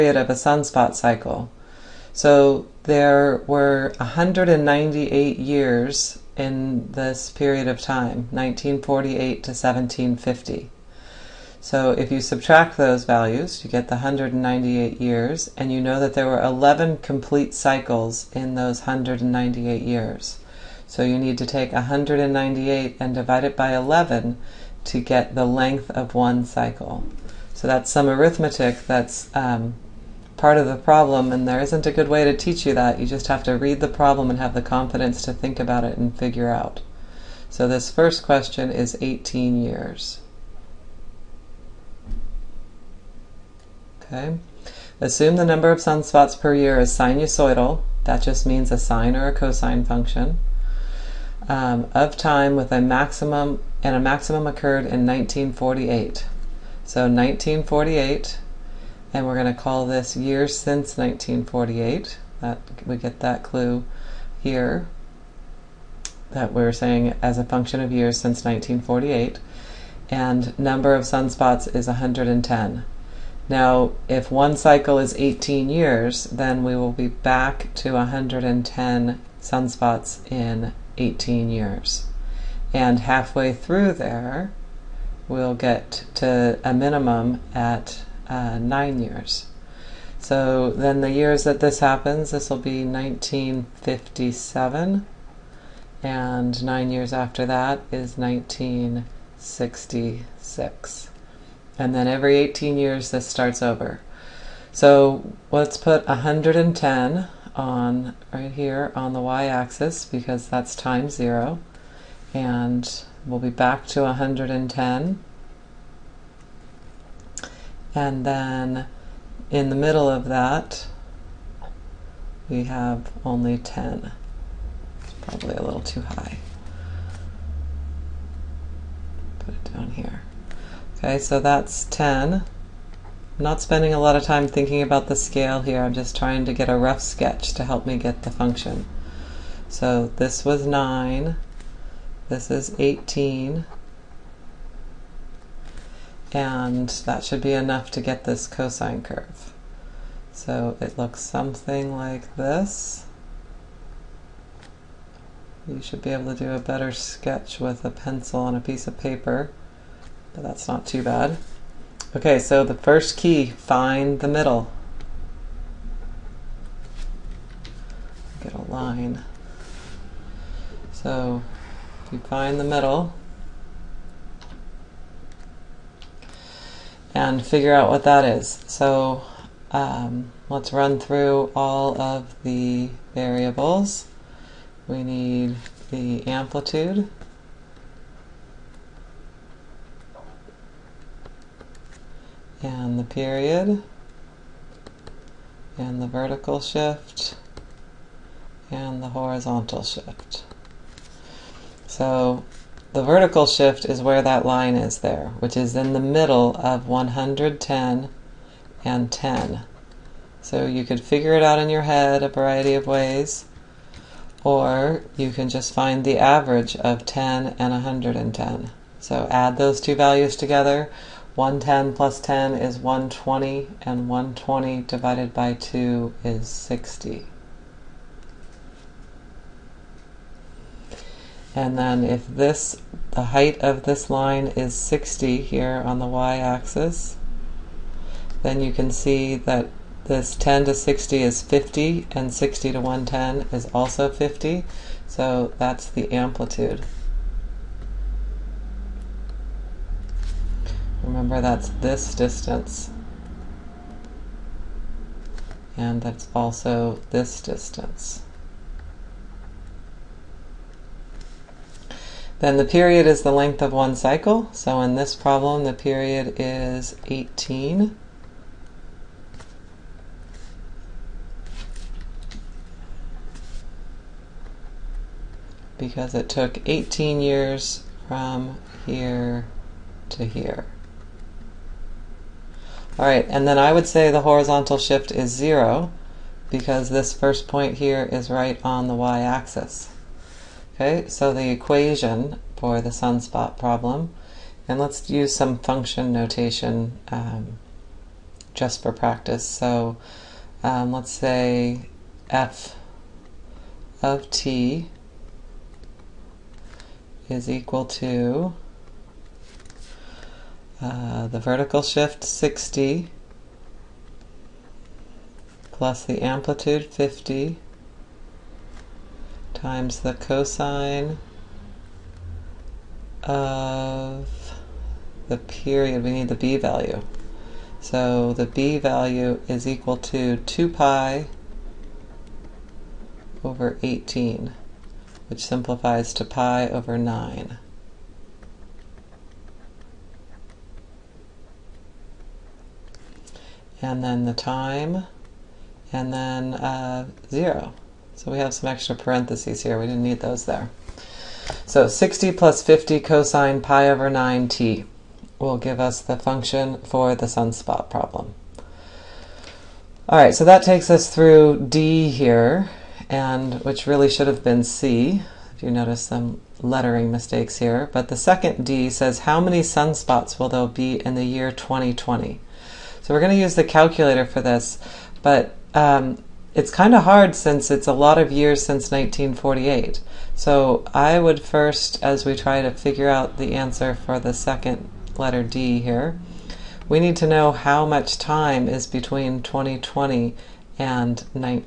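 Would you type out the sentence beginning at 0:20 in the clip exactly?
So you need to take 198 and divide it by 11 to get the length of one cycle.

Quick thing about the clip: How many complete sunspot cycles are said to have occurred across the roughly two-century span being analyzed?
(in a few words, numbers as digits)
11.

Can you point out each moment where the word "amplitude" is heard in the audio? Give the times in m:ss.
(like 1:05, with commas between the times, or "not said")
3:06, 4:06, 5:16.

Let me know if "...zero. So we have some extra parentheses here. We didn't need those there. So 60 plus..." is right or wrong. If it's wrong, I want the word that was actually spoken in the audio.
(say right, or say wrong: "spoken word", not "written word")
right.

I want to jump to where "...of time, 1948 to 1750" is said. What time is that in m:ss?
0:07.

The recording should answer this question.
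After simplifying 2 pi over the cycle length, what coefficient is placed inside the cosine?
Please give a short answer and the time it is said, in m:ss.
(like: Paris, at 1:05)
pi over 9, at 5:36.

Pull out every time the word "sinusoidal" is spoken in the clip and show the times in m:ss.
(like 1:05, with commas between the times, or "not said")
0:46.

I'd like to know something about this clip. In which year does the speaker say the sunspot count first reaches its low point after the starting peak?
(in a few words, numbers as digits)
1957.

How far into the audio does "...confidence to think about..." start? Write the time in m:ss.
0:34.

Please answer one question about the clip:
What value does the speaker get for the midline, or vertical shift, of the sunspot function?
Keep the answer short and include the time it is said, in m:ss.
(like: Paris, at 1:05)
60, at 3:44.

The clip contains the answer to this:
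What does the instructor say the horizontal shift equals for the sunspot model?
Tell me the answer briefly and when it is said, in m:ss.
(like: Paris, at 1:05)
0, at 4:44.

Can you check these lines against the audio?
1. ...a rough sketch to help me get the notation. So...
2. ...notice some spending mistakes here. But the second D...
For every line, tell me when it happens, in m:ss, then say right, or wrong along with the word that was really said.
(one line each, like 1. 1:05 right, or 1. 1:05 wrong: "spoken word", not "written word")
1. 2:16 wrong: "function", not "notation"
2. 6:05 wrong: "lettering", not "spending".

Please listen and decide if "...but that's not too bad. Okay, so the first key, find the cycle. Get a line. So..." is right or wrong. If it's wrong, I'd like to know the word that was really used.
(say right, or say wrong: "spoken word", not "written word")
wrong: "middle", not "cycle".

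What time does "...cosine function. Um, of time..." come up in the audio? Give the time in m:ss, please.
0:49.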